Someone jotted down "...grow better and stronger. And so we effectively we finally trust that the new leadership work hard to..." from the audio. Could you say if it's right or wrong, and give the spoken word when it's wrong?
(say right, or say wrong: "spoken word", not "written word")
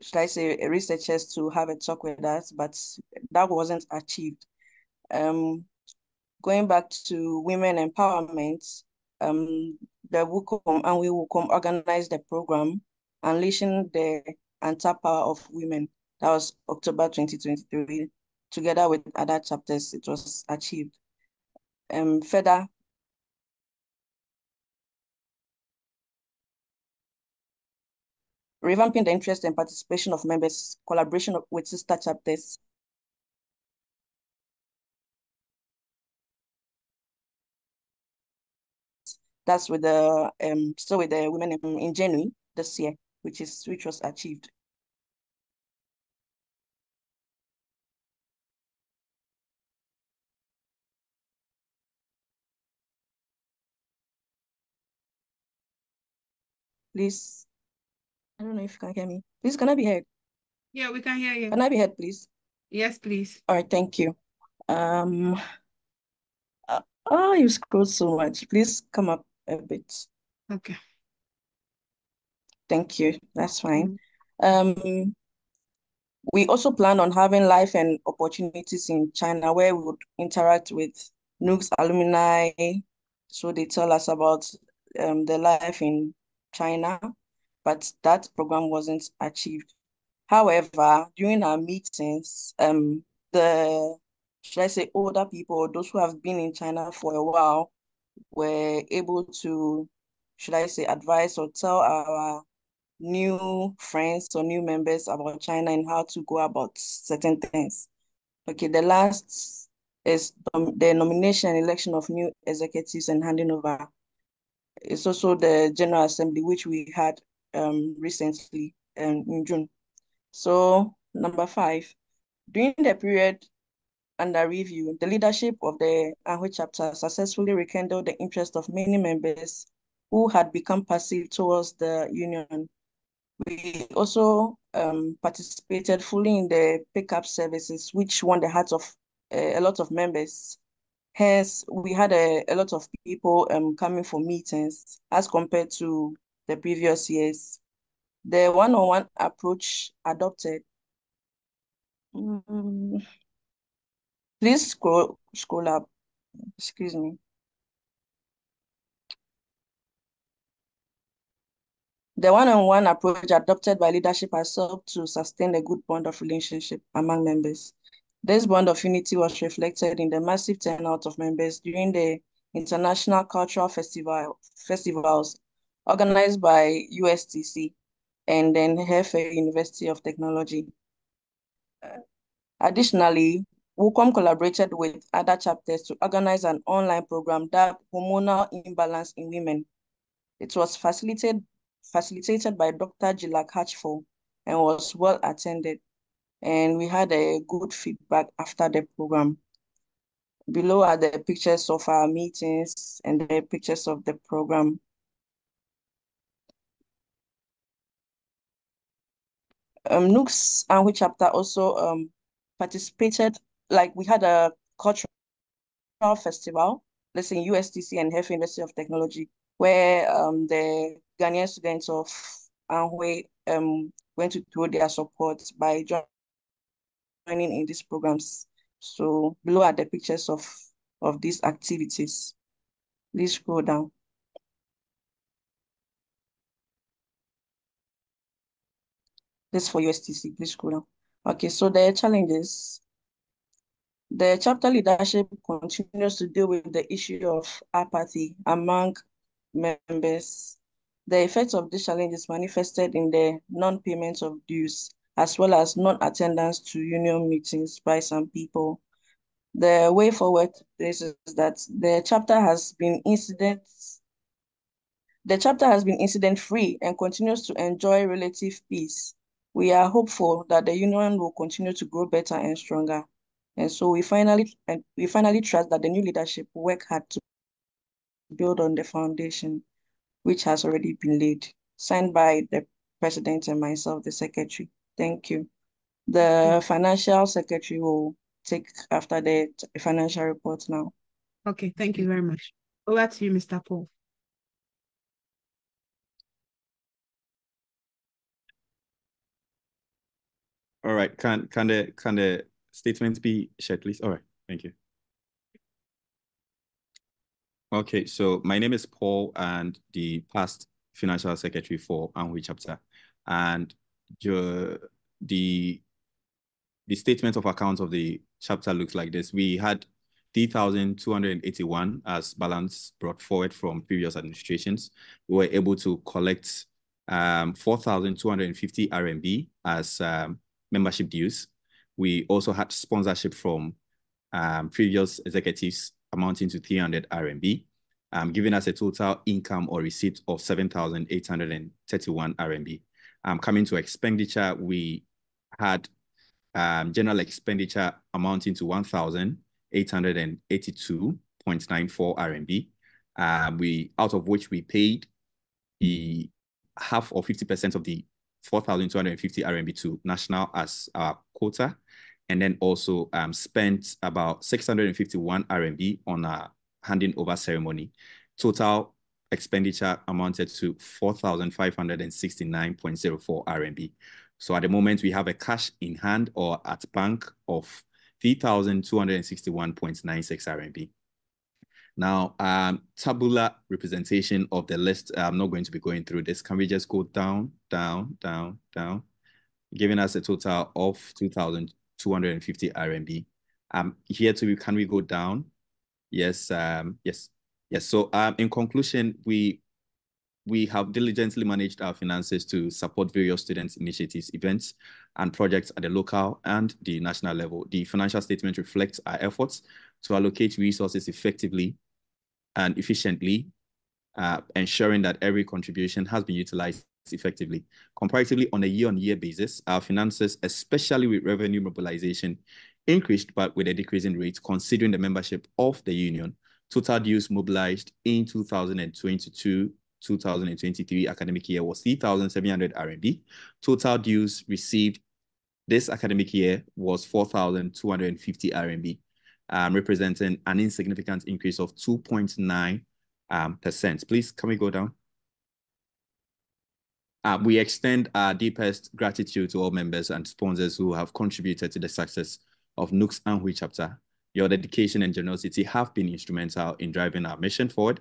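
wrong: "finally", not "effectively".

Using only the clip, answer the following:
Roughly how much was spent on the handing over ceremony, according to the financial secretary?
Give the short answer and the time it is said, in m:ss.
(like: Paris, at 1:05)
651 RMB, at 6:04.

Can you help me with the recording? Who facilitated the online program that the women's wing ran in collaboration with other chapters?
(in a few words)
Dr. Jilak Hatchful.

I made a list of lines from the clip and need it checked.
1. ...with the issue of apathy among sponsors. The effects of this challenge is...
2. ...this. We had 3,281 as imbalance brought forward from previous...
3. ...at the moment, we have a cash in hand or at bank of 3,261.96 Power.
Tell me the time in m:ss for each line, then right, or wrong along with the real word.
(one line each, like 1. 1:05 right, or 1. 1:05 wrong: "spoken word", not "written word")
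1. 4:06 wrong: "members", not "sponsors"
2. 5:19 wrong: "balance", not "imbalance"
3. 6:14 wrong: "RMB", not "Power".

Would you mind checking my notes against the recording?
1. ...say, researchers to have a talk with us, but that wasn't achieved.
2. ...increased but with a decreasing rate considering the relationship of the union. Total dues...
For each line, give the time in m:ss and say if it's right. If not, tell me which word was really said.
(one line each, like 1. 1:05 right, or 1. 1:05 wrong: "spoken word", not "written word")
1. 0:00 right
2. 7:02 wrong: "membership", not "relationship".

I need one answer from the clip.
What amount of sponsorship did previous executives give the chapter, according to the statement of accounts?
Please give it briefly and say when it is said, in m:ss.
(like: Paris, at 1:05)
300 RMB, at 5:36.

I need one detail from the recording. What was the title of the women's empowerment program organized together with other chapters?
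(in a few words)
Unleashing the Untapped Power of Women.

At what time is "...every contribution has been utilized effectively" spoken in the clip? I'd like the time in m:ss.
6:55.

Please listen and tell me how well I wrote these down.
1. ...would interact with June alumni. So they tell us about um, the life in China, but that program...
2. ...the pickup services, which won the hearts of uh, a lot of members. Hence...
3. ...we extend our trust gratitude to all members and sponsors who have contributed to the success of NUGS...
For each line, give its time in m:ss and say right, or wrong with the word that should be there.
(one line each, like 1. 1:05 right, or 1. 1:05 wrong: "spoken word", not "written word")
1. 1:19 wrong: "NUGS", not "June"
2. 2:16 right
3. 7:27 wrong: "deepest", not "trust".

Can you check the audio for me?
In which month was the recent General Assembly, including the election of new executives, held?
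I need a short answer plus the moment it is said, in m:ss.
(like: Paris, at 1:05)
June, at 1:59.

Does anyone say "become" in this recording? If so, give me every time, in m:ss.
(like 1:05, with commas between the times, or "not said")
2:10.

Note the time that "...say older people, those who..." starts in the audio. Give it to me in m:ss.
1:34.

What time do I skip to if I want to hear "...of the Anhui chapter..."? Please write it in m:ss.
2:05.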